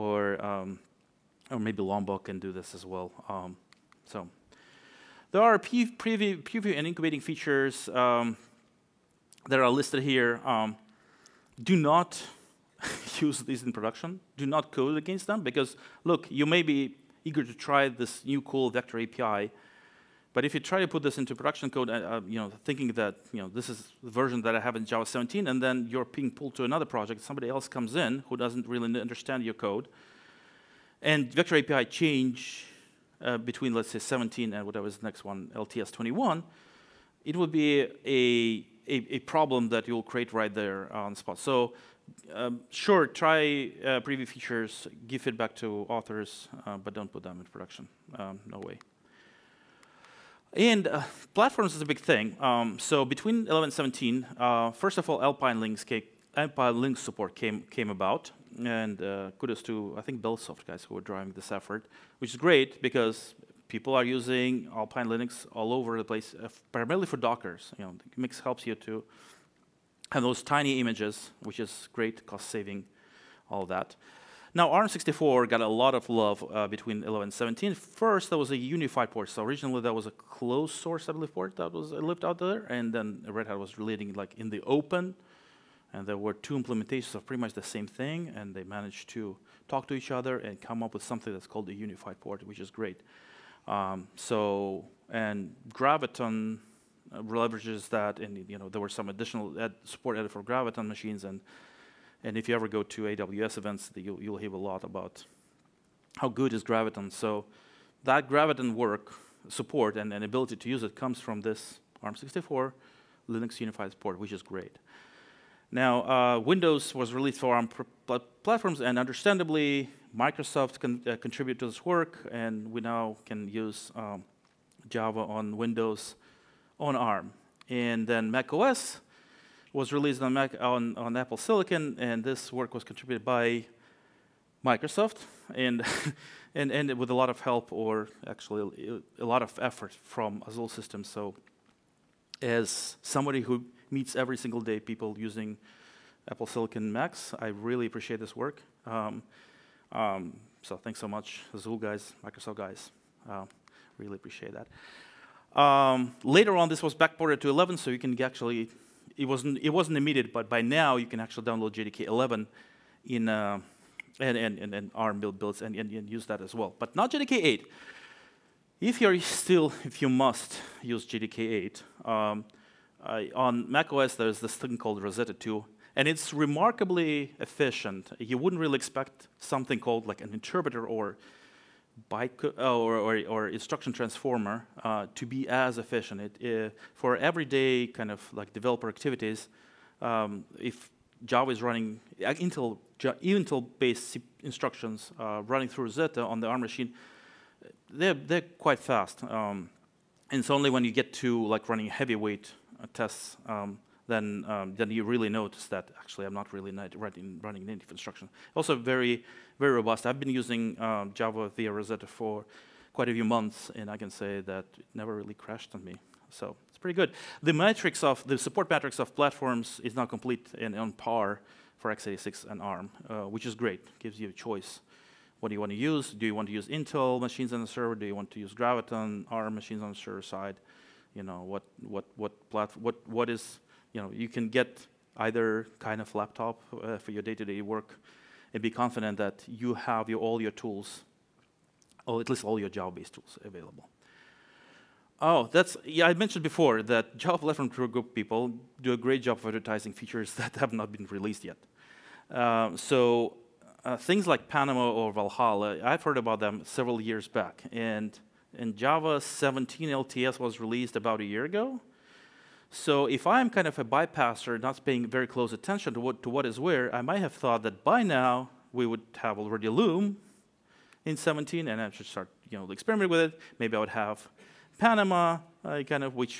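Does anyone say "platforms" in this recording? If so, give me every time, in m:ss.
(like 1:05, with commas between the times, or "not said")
0:51, 1:58, 3:39, 3:52, 4:07.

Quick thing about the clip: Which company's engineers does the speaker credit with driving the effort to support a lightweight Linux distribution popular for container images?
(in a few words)
Bellsoft.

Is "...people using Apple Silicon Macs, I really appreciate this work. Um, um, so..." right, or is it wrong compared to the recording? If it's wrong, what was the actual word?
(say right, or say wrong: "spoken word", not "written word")
right.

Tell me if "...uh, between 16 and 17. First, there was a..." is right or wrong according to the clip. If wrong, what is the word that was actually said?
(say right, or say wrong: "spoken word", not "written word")
wrong: "11", not "16".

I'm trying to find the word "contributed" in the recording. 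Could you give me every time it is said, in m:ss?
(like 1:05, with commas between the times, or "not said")
2:01, 2:12.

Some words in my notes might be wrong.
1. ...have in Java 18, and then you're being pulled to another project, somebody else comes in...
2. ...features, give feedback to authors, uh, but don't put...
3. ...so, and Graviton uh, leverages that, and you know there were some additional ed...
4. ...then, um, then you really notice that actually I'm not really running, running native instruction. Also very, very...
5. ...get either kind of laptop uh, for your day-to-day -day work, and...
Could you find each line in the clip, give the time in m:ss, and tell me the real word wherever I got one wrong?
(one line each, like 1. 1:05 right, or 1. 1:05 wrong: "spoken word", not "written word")
1. 0:24 wrong: "17", not "18"
2. 0:44 right
3. 1:34 right
4. 3:24 right
5. 3:54 right.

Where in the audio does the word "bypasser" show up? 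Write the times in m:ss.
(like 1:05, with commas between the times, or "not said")
4:23.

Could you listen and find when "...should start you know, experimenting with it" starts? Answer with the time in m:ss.
4:31.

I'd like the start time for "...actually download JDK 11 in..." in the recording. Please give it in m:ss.
2:41.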